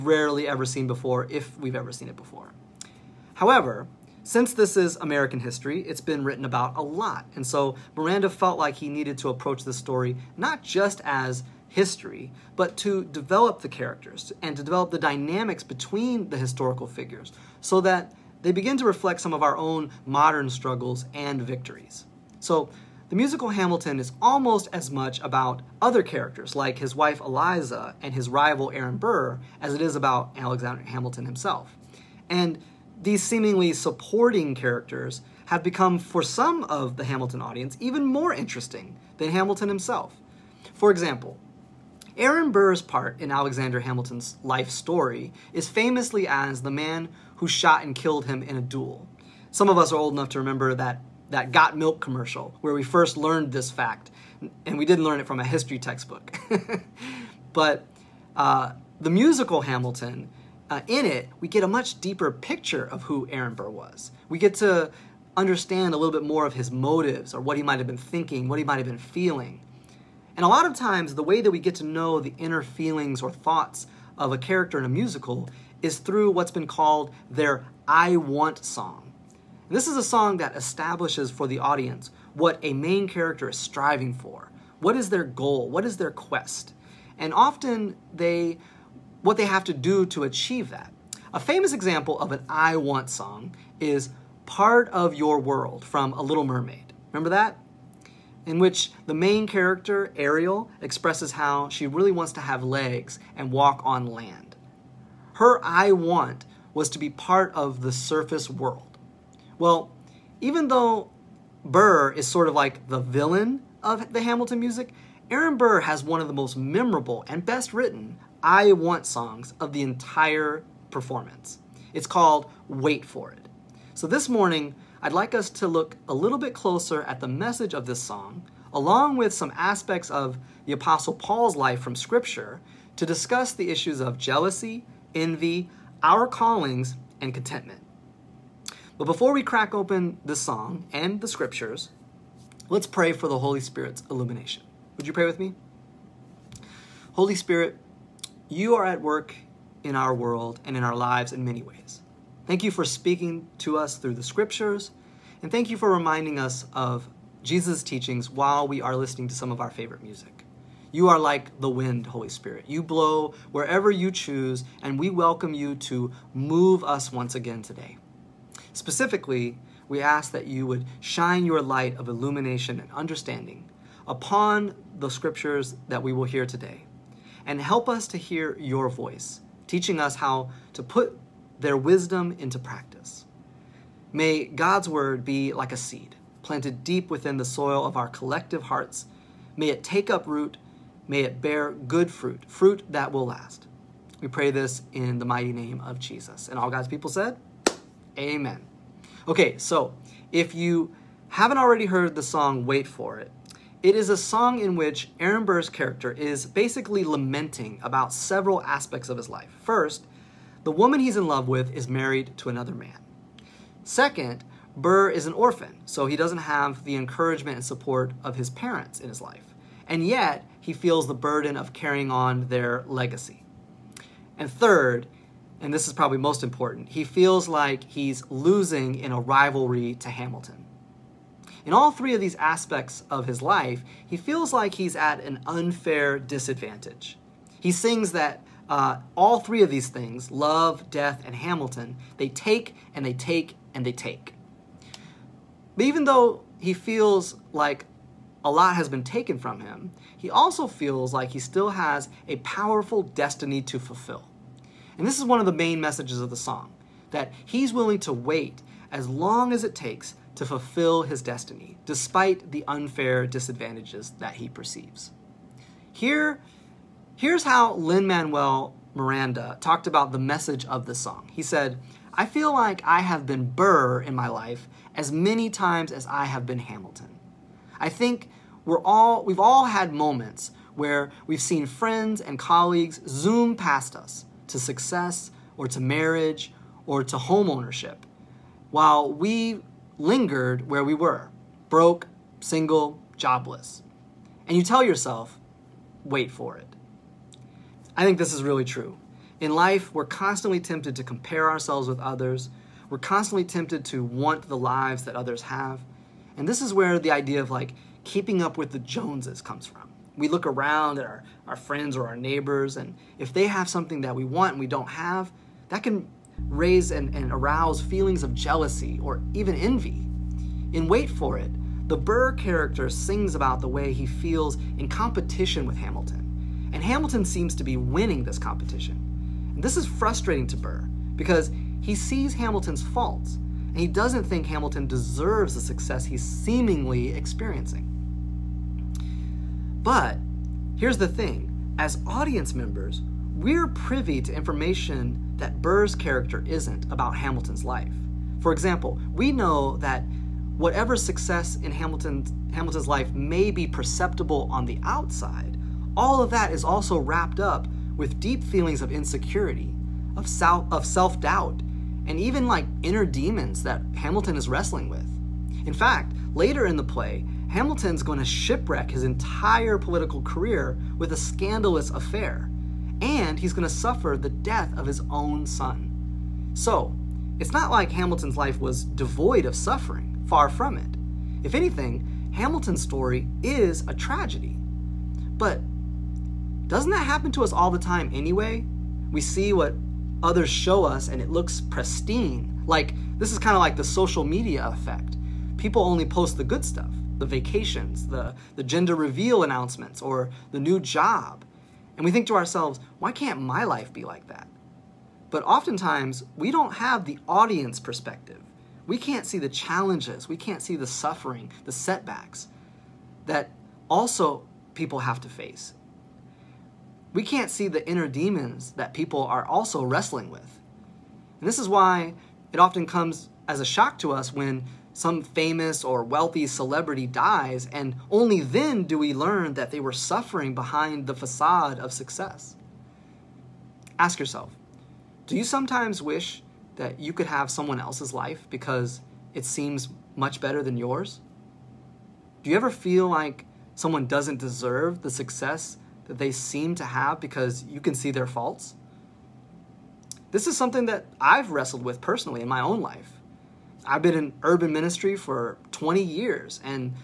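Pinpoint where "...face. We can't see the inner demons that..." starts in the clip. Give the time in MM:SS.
06:55.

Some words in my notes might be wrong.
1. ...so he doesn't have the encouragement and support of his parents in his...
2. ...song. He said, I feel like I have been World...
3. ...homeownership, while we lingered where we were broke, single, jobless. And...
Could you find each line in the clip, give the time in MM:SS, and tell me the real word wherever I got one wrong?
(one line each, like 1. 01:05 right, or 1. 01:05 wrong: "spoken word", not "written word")
1. 03:35 right
2. 04:30 wrong: "Burr", not "World"
3. 04:47 right.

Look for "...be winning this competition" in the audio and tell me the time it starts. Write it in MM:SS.
05:27.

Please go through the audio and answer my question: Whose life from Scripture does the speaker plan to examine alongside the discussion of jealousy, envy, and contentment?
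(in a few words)
Apostle Paul.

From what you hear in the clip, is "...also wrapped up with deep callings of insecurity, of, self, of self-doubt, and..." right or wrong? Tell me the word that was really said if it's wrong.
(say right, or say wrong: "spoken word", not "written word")
wrong: "feelings", not "callings".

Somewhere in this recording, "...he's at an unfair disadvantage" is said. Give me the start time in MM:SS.
03:54.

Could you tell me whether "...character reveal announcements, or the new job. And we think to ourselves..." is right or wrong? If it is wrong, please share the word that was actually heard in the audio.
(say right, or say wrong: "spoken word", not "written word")
wrong: "gender", not "character".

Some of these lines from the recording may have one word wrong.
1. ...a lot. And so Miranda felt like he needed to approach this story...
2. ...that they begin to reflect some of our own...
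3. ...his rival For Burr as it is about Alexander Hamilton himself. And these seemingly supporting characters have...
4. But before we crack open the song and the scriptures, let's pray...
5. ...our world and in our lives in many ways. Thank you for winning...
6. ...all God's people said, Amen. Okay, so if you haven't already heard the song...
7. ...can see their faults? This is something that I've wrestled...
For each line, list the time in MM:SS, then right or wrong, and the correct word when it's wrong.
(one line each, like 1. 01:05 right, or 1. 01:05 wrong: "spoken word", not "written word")
1. 00:06 right
2. 00:17 right
3. 00:28 wrong: "Aaron", not "For"
4. 02:18 right
5. 02:29 wrong: "speaking", not "winning"
6. 03:16 right
7. 07:27 right.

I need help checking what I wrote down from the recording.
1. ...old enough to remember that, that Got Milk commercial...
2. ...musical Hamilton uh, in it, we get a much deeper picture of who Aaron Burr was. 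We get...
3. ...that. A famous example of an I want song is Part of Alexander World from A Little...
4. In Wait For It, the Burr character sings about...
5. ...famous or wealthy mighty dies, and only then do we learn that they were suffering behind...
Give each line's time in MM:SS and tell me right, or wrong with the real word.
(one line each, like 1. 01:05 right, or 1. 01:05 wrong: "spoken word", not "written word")
1. 00:49 right
2. 00:59 right
3. 01:30 wrong: "Your", not "Alexander"
4. 05:20 right
5. 07:05 wrong: "celebrity", not "mighty".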